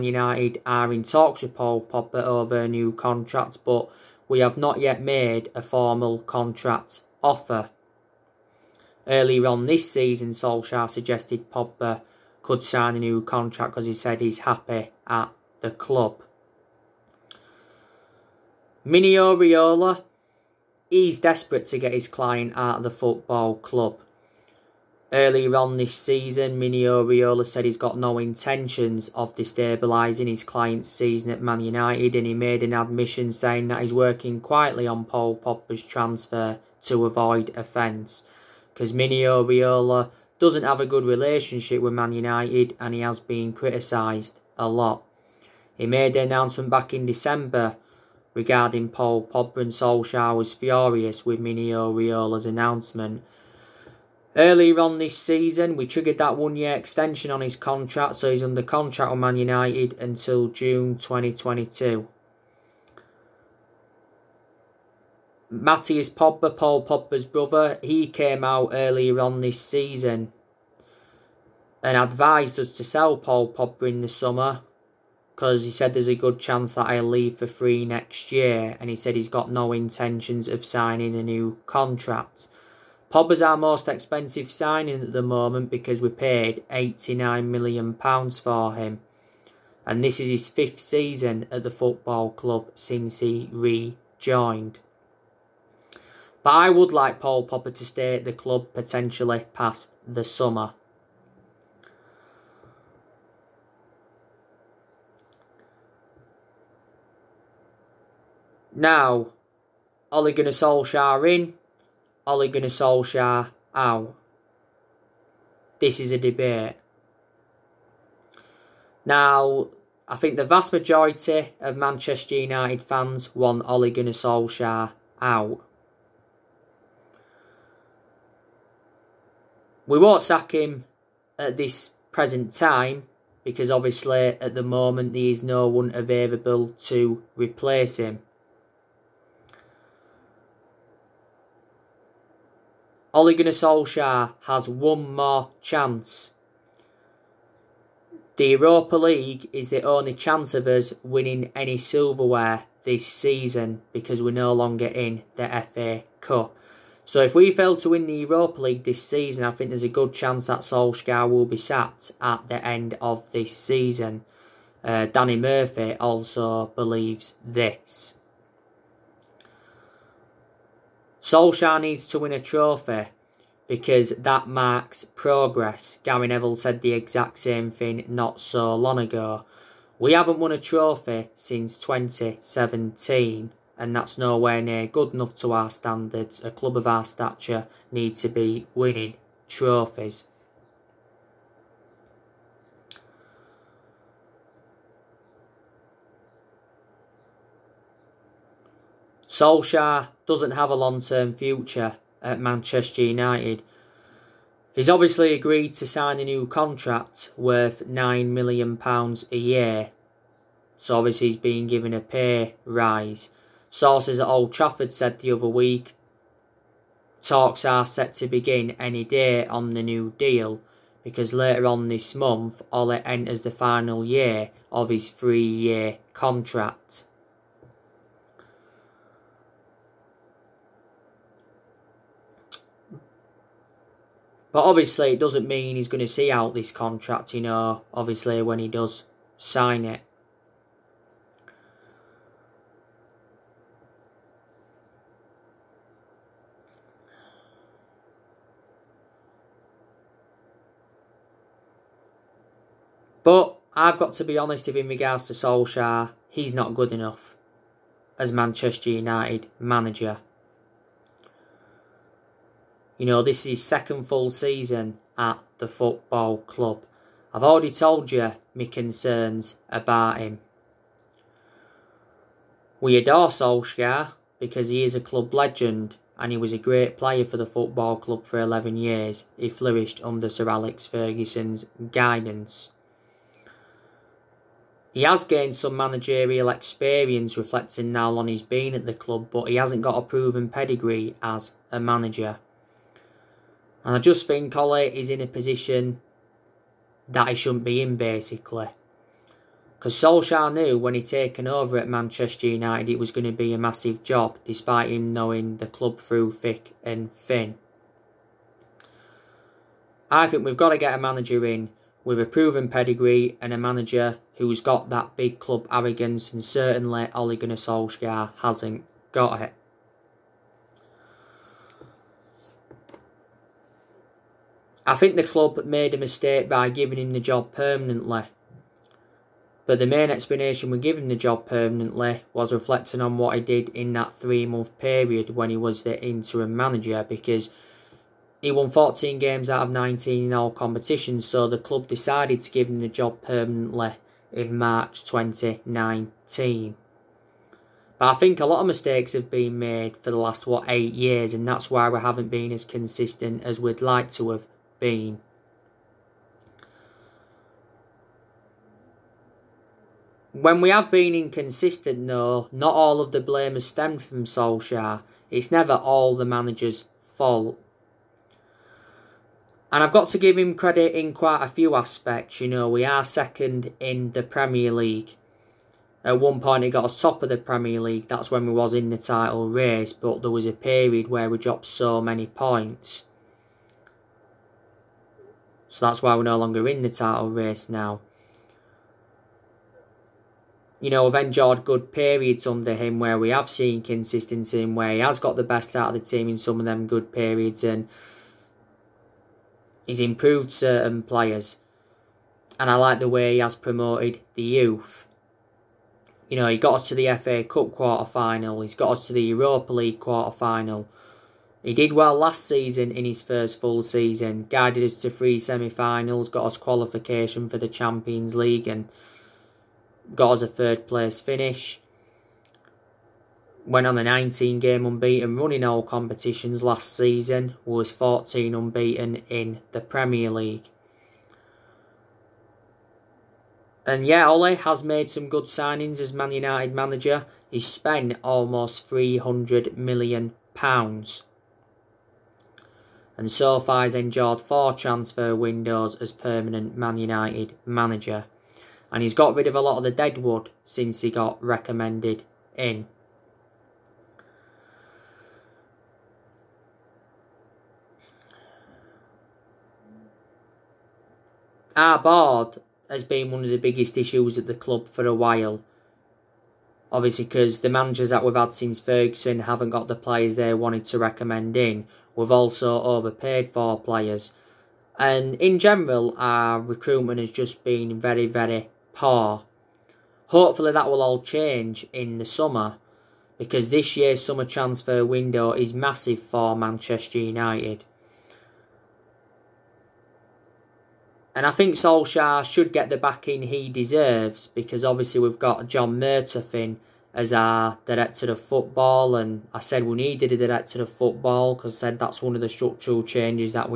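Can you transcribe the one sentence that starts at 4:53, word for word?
And I just think Ollie is in a position that he shouldn't be in, basically.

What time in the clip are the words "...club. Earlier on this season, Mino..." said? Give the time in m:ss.
0:23.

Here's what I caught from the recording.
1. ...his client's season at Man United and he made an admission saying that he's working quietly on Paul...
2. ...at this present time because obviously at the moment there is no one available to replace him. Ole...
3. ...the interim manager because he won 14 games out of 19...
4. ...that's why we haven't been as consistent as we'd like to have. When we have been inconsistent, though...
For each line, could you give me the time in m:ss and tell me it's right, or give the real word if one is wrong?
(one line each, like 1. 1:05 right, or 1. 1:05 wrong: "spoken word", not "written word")
1. 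0:30 right
2. 2:11 right
3. 5:35 right
4. 5:51 right.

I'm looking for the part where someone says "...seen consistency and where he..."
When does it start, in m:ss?
6:33.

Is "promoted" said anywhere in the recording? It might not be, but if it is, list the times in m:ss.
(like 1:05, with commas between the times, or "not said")
6:43.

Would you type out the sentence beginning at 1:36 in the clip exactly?
But I would like Paul Pogba to stay at the club potentially past the summer.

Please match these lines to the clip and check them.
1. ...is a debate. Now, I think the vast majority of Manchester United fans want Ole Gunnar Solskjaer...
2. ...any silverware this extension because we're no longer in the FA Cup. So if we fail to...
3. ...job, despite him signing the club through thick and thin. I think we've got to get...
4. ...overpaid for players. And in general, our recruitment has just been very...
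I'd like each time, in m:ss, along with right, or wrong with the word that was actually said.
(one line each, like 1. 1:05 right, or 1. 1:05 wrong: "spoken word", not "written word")
1. 1:55 right
2. 2:31 wrong: "season", not "extension"
3. 5:04 wrong: "knowing", not "signing"
4. 7:52 right.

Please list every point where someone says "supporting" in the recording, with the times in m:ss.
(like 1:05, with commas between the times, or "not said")
not said.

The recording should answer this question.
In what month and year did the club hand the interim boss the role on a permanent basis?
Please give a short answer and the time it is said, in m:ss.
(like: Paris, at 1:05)
March 2019, at 5:44.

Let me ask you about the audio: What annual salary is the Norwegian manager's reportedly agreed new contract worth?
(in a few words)
£9 million a year.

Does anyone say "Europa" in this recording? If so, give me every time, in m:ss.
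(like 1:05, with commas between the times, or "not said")
2:28, 2:38, 6:49.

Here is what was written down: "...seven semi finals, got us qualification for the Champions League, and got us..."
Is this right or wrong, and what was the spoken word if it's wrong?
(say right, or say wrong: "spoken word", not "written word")
wrong: "three", not "seven".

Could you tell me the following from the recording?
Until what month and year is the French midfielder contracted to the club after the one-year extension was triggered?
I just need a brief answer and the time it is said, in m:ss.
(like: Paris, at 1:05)
June 2022, at 1:00.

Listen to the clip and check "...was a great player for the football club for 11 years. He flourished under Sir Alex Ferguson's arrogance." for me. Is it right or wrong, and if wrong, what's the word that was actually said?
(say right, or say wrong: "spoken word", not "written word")
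wrong: "guidance", not "arrogance".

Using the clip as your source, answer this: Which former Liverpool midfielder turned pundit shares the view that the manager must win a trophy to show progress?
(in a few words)
Danny Murphy.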